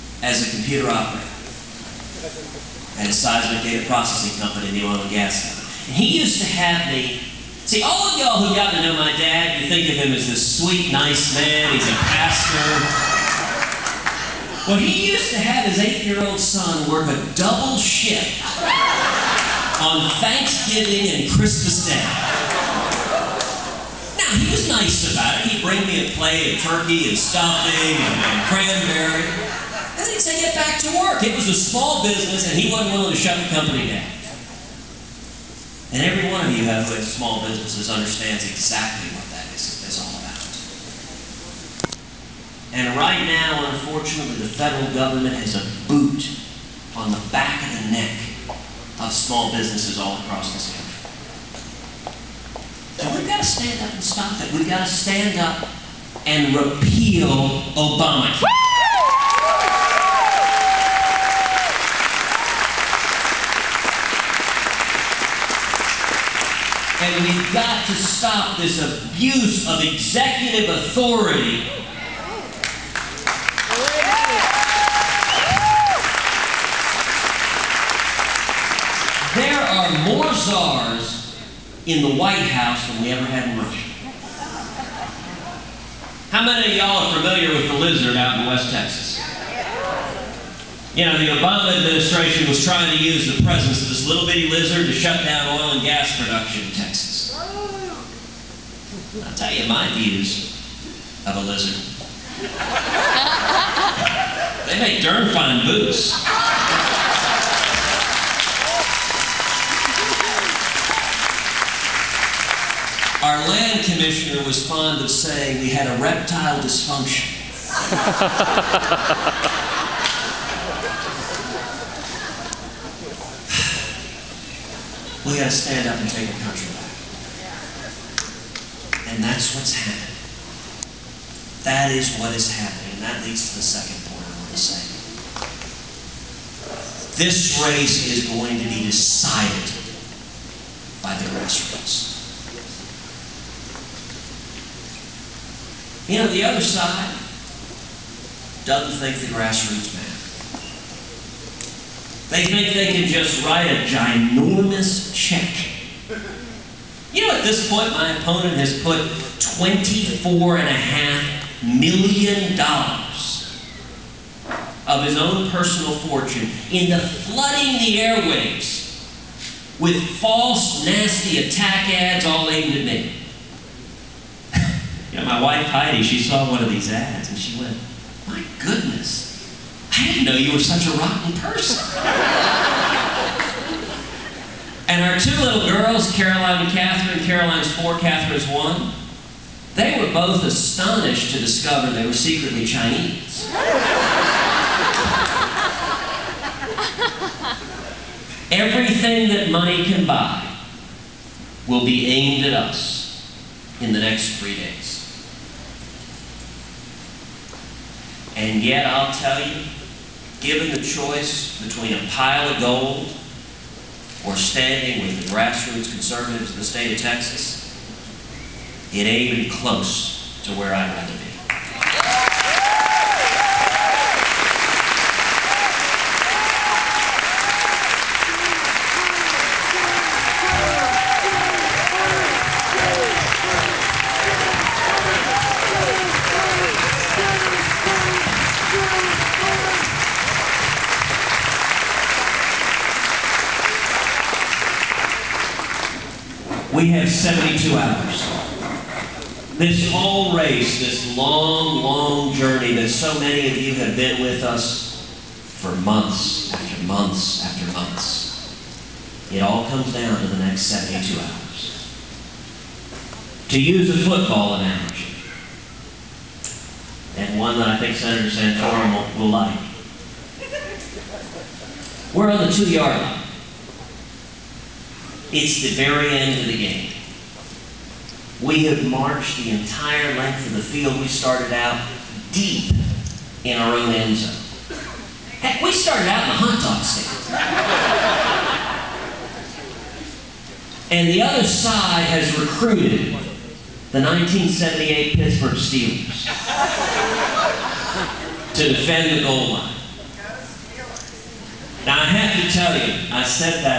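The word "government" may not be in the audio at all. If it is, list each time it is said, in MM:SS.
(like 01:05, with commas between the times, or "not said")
00:44.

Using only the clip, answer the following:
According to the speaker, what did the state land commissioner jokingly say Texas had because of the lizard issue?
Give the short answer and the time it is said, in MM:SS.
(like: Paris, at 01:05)
reptile dysfunction, at 01:56.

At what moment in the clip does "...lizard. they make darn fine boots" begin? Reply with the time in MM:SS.
01:41.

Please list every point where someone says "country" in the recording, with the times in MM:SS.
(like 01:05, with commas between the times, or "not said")
00:50, 02:06.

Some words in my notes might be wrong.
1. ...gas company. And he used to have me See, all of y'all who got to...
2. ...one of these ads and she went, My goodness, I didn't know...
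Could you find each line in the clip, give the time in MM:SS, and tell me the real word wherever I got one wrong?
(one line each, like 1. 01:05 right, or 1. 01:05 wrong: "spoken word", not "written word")
1. 00:05 right
2. 02:56 right.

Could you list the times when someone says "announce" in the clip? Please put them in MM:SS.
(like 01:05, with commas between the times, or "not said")
not said.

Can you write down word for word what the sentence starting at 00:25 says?
He'd bring me a plate of turkey and stuffing and, and cranberry.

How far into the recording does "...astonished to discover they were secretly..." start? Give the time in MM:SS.
03:10.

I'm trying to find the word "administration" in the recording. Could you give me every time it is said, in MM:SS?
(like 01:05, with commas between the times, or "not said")
01:31.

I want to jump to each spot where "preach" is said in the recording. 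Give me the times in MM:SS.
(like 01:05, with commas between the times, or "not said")
not said.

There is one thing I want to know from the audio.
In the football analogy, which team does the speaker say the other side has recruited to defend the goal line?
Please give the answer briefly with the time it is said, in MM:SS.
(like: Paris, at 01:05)
1978 Pittsburgh Steelers, at 04:54.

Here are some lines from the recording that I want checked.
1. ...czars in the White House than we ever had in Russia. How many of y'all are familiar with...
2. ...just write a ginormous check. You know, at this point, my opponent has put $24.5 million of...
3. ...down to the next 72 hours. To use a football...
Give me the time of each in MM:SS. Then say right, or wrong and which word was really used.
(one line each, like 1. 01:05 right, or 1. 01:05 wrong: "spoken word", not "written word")
1. 01:20 right
2. 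02:33 right
3. 04:19 right.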